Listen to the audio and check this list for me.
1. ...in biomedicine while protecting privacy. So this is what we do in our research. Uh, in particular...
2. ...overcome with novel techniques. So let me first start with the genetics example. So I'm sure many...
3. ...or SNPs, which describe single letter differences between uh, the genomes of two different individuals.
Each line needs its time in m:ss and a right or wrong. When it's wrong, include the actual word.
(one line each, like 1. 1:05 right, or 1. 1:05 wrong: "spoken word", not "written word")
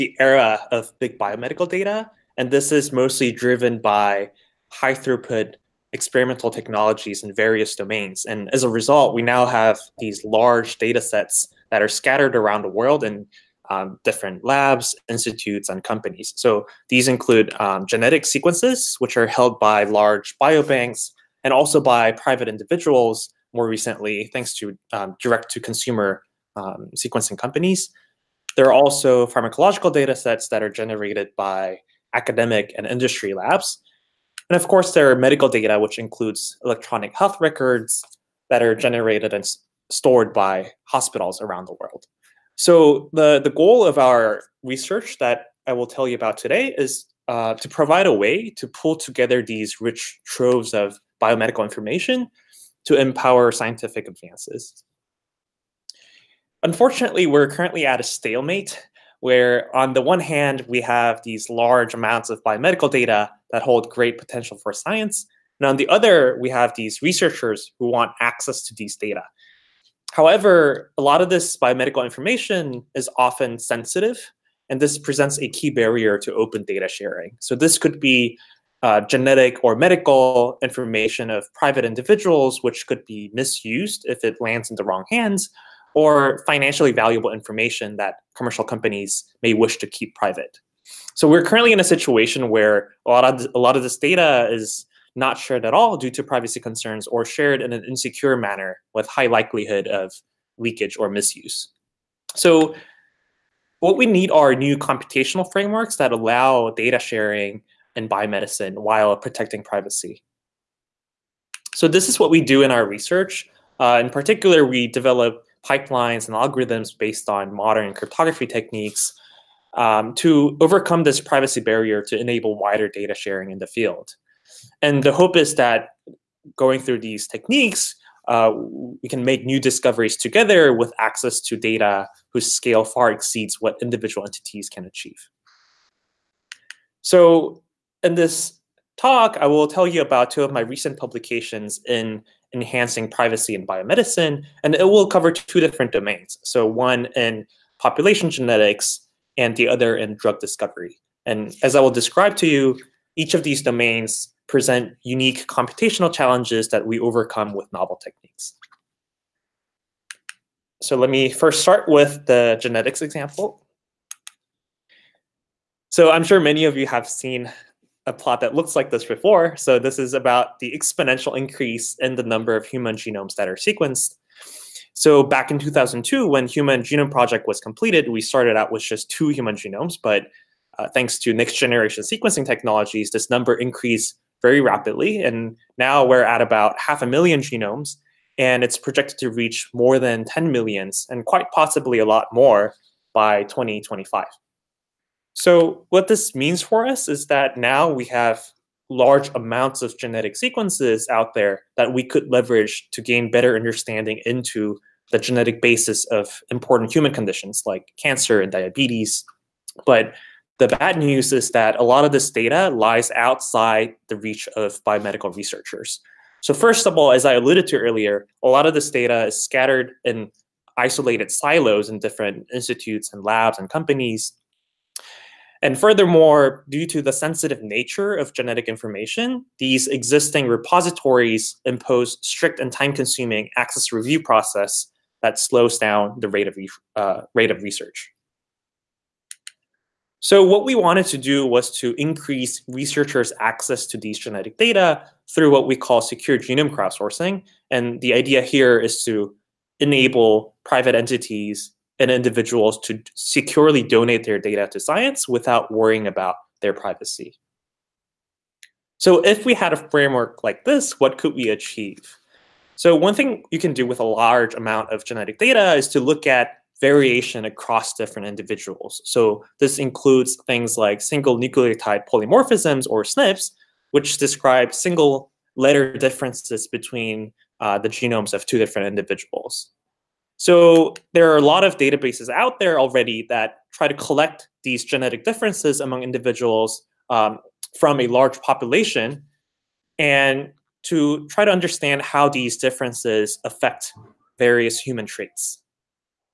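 1. 1:47 right
2. 2:36 right
3. 4:32 right.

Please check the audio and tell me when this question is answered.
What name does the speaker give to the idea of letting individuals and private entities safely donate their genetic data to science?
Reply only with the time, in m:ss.
4:06.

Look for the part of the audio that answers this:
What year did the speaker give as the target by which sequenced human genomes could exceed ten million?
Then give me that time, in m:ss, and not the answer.
3:13.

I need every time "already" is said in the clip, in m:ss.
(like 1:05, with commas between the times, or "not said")
4:42.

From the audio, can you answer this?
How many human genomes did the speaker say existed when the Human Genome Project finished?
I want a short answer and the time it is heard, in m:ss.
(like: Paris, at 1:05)
2, at 2:59.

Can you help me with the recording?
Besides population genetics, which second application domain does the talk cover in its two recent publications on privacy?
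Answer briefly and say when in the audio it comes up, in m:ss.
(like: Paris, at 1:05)
drug discovery, at 2:30.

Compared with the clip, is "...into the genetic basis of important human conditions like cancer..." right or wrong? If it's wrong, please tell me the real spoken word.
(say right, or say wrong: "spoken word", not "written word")
right.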